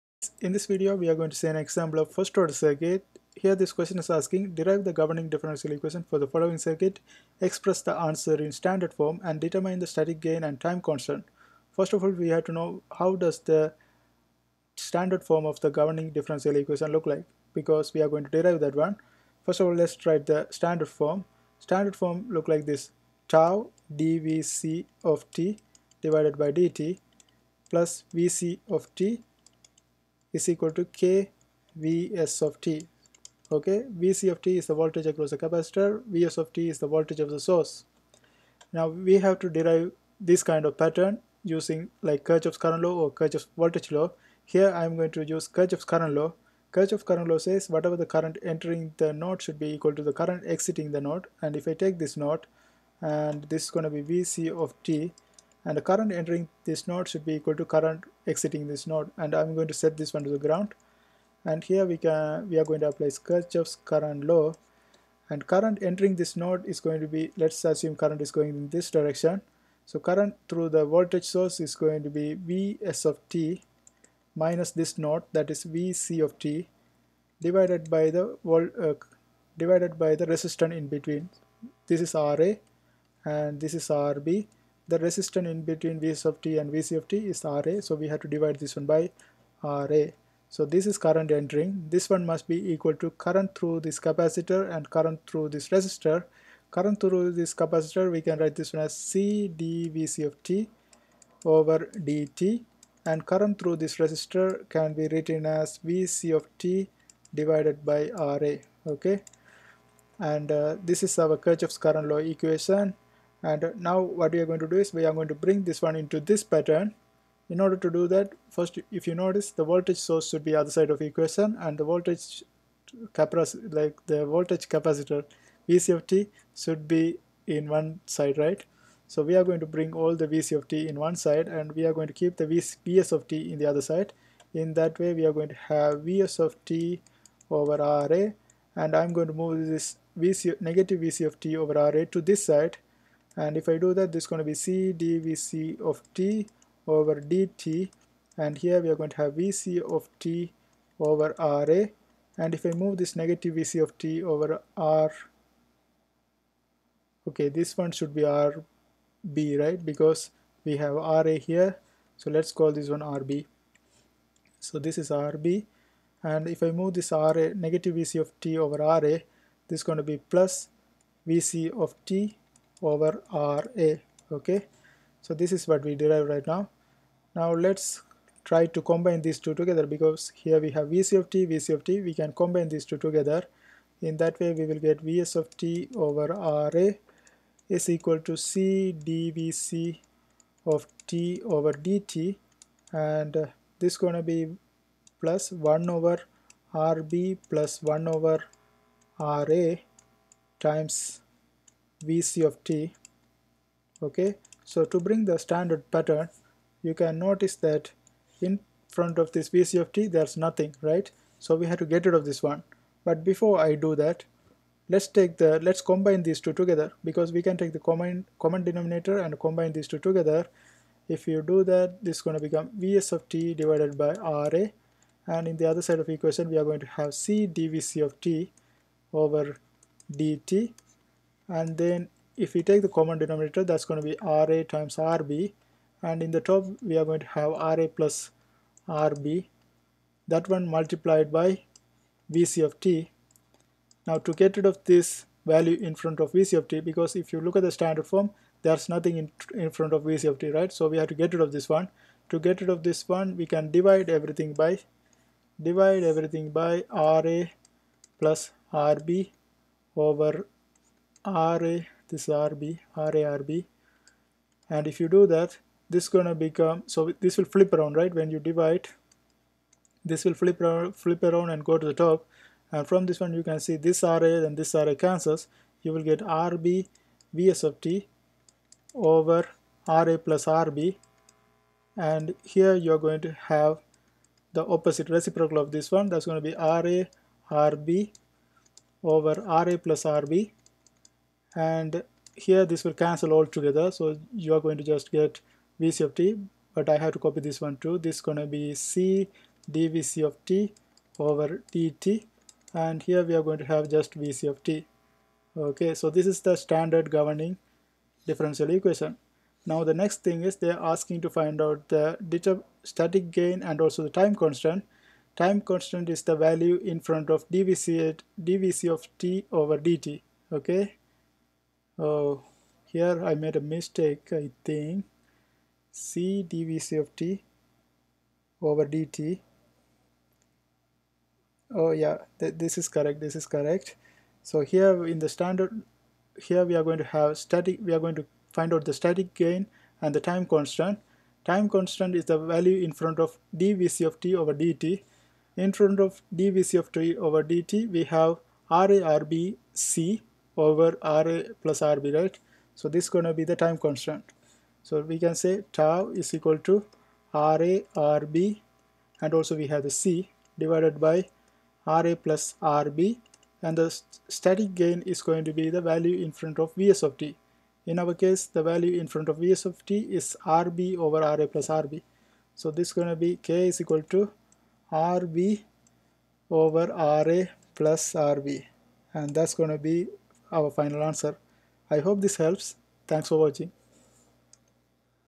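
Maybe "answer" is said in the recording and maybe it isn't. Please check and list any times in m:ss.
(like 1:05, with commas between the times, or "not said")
0:07, 6:21.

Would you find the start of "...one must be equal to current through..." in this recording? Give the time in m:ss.
1:32.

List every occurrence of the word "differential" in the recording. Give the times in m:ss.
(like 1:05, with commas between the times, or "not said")
0:05, 0:16, 5:08.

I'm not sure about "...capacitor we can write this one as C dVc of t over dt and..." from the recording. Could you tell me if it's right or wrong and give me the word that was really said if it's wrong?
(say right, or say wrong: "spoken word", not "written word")
right.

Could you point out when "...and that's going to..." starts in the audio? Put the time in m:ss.
6:19.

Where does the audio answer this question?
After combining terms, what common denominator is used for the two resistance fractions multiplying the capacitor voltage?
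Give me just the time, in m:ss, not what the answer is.
3:54.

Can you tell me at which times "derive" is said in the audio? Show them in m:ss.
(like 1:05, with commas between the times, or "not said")
0:04, 0:18, 0:39, 2:55.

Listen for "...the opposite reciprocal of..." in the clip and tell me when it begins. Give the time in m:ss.
4:44.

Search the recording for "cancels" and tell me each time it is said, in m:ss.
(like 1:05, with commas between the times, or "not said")
4:34, 4:52.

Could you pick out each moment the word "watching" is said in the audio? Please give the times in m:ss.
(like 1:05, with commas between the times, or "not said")
6:23.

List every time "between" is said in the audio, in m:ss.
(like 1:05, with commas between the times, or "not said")
1:20, 1:25.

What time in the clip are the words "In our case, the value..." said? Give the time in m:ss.
6:07.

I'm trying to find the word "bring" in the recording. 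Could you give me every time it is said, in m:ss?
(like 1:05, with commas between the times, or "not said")
1:55, 2:09, 3:24.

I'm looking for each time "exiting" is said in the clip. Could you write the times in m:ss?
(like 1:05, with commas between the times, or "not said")
0:50, 0:58.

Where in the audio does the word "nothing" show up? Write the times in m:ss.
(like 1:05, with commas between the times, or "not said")
3:30, 4:08.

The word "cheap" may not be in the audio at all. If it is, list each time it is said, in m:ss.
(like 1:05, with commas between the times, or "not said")
not said.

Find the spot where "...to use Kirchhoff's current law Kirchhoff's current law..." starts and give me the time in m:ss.
0:45.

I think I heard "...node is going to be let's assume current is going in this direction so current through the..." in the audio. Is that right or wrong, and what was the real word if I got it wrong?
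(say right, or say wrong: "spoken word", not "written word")
right.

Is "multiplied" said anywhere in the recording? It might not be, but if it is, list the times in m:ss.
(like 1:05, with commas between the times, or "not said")
4:00.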